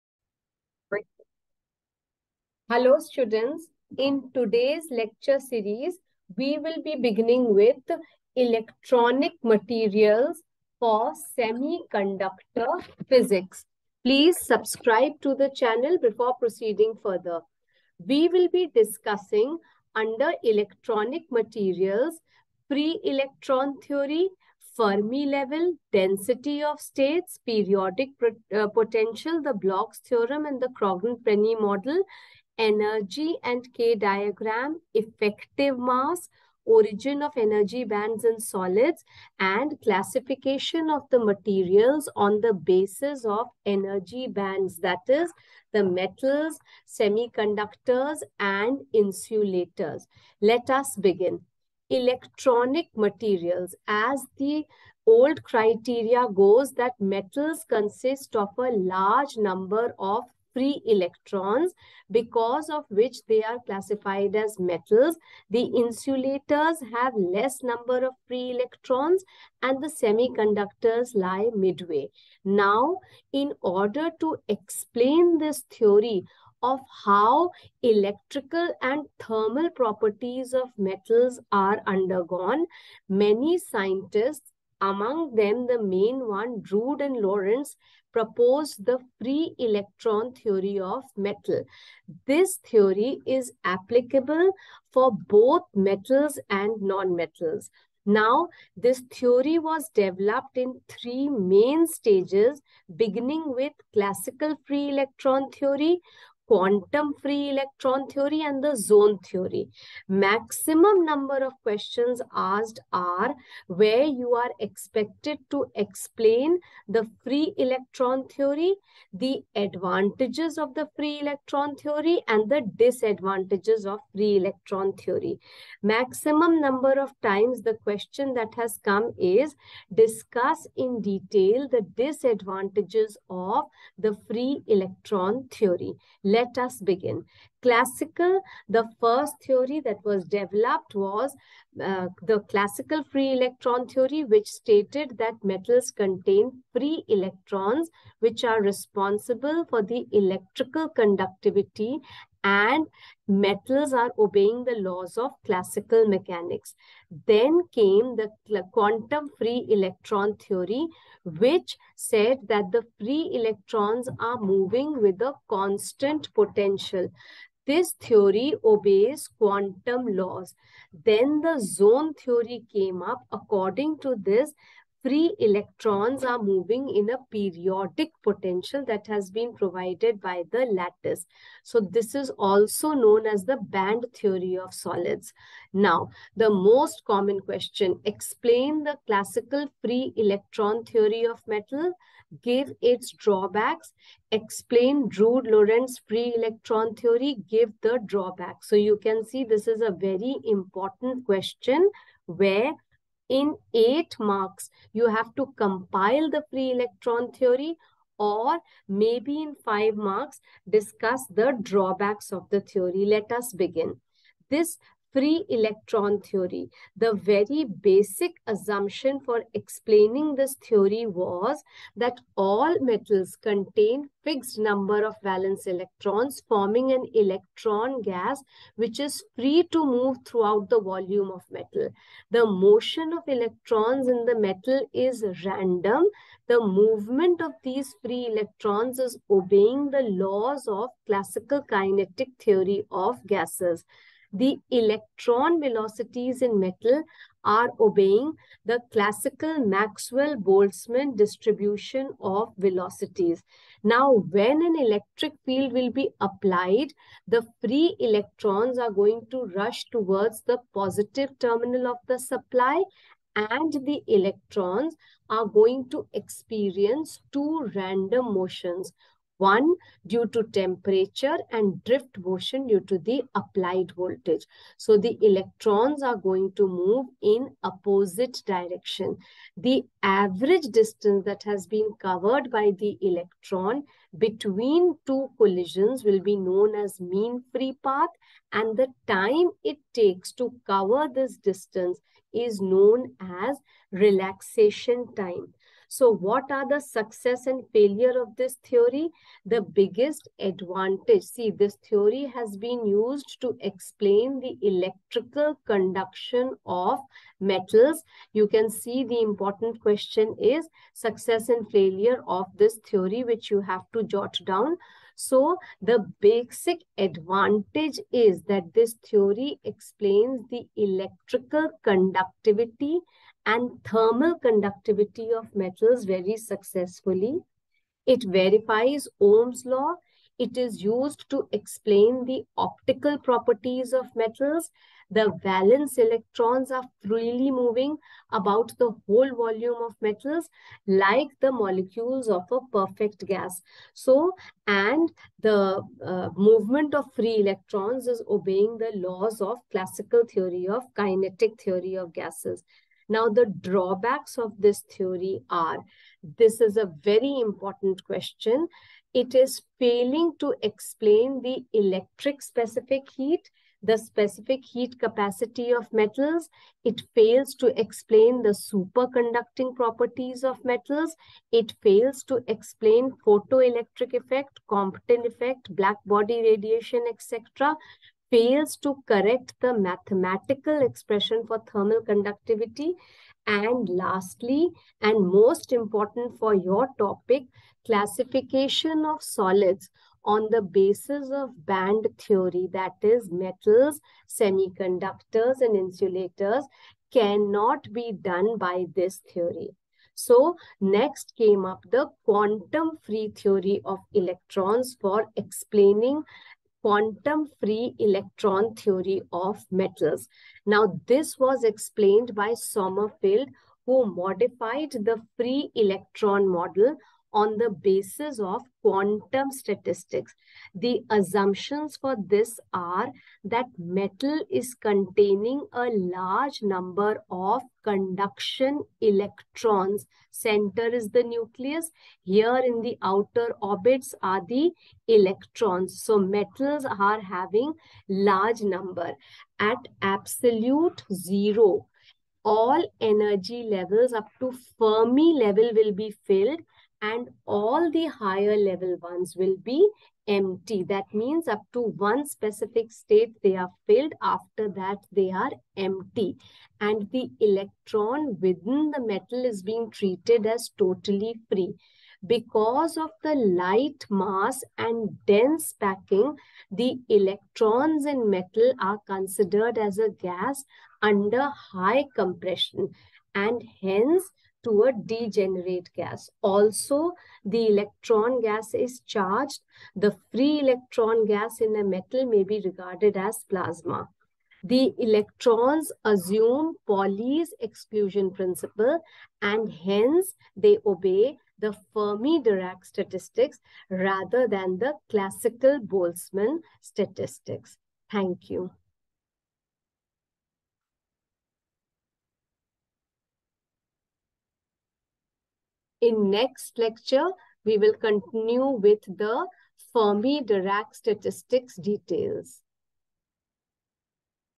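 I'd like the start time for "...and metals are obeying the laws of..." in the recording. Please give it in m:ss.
2:32.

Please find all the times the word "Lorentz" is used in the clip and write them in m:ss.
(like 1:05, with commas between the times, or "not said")
1:27, 3:15.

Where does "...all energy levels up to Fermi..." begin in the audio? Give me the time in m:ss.
7:22.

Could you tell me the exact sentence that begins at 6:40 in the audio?
So next came up the quantum free theory of electrons for explaining quantum free electron theory of metals.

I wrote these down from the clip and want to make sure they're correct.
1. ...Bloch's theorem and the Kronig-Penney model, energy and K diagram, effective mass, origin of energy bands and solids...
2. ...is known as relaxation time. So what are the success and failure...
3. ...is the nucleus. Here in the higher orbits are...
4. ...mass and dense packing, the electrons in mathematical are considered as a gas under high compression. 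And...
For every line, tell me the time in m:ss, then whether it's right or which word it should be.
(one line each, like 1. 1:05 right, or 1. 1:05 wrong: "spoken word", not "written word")
1. 0:29 right
2. 4:52 right
3. 7:10 wrong: "outer", not "higher"
4. 7:44 wrong: "metal", not "mathematical".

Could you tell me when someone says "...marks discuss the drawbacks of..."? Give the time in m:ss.
3:29.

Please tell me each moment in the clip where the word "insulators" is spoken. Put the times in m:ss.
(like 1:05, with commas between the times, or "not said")
0:48, 1:05, 6:35.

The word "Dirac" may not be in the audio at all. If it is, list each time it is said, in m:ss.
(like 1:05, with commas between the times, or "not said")
8:11, 8:29.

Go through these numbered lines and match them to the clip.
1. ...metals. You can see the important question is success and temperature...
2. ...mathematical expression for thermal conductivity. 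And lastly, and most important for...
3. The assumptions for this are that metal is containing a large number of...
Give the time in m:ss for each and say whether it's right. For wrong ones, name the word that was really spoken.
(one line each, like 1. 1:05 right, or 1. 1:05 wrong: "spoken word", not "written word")
1. 5:07 wrong: "failure", not "temperature"
2. 6:19 right
3. 7:00 right.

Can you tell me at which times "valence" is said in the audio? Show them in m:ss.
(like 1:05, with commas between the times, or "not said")
3:45, 5:35.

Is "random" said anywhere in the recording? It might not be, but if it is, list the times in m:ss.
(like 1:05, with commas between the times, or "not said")
3:55, 4:27.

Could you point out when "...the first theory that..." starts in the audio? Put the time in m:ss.
2:18.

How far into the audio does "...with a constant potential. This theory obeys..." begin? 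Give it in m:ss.
2:45.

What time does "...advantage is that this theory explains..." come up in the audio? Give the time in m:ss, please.
5:16.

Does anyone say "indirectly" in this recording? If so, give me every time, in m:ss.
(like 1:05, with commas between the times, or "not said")
not said.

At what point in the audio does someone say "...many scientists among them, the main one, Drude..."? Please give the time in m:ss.
1:23.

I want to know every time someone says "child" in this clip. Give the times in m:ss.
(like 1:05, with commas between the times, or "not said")
not said.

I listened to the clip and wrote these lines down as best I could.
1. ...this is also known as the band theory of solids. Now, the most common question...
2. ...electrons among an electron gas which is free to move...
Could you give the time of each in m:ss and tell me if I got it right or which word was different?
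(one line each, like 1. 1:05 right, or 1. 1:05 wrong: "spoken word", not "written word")
1. 3:01 right
2. 3:45 wrong: "forming", not "among".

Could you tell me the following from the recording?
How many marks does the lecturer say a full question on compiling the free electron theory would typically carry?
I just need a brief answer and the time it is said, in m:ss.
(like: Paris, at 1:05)
8, at 3:23.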